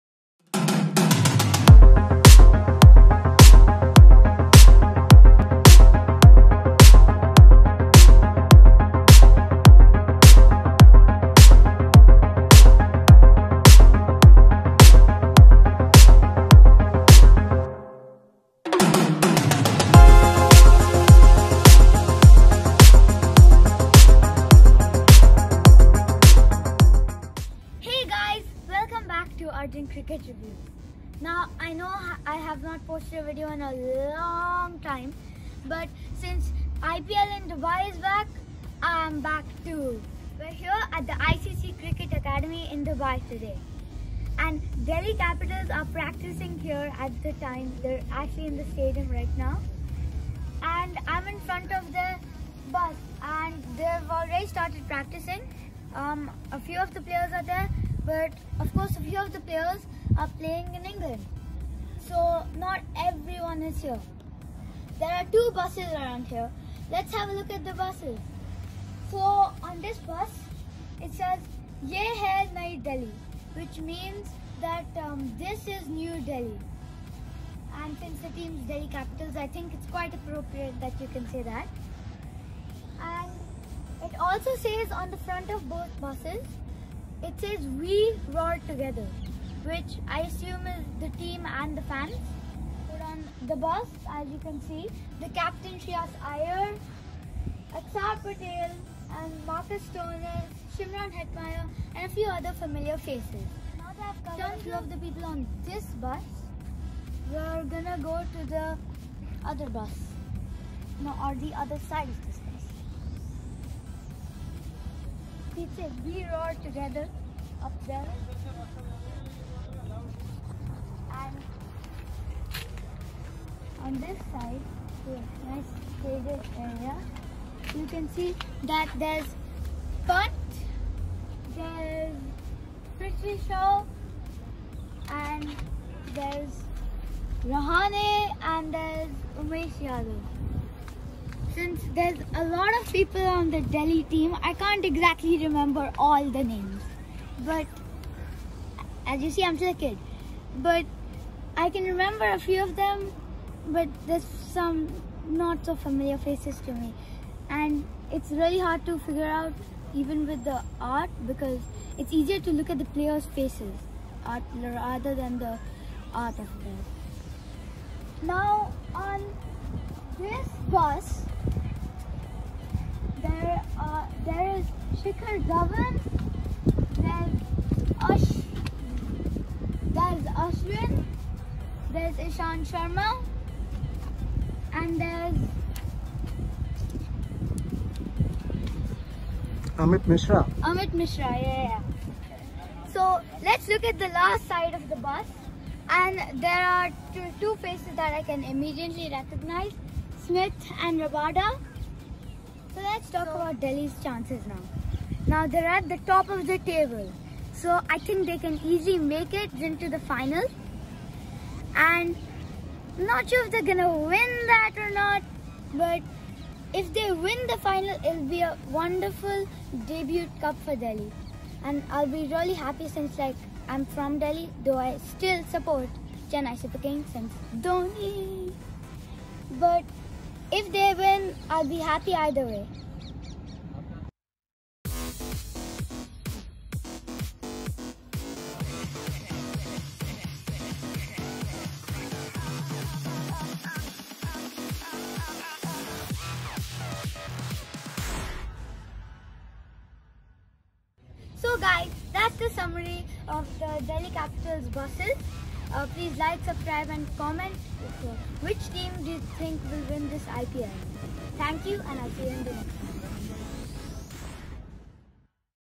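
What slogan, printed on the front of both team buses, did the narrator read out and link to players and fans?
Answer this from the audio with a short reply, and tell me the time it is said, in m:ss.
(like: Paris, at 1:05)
We roar together, at 1:27.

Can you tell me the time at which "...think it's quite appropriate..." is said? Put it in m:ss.
1:19.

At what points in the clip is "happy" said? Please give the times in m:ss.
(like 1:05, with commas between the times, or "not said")
3:42, 3:51.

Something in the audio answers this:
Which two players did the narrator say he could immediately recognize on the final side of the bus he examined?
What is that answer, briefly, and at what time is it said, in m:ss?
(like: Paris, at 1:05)
Smith and Rabada, at 3:20.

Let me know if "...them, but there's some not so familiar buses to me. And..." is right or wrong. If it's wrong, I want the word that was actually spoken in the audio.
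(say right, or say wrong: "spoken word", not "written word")
wrong: "faces", not "buses".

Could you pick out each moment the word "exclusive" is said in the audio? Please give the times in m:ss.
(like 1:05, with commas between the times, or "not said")
not said.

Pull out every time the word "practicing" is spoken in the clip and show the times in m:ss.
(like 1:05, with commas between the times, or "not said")
0:45, 0:54.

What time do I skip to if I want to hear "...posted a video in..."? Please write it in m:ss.
0:32.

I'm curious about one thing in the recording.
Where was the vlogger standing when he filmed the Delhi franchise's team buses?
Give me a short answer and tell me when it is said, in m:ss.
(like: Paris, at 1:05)
ICC Cricket Academy, at 0:41.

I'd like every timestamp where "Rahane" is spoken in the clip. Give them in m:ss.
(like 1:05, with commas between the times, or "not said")
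2:17.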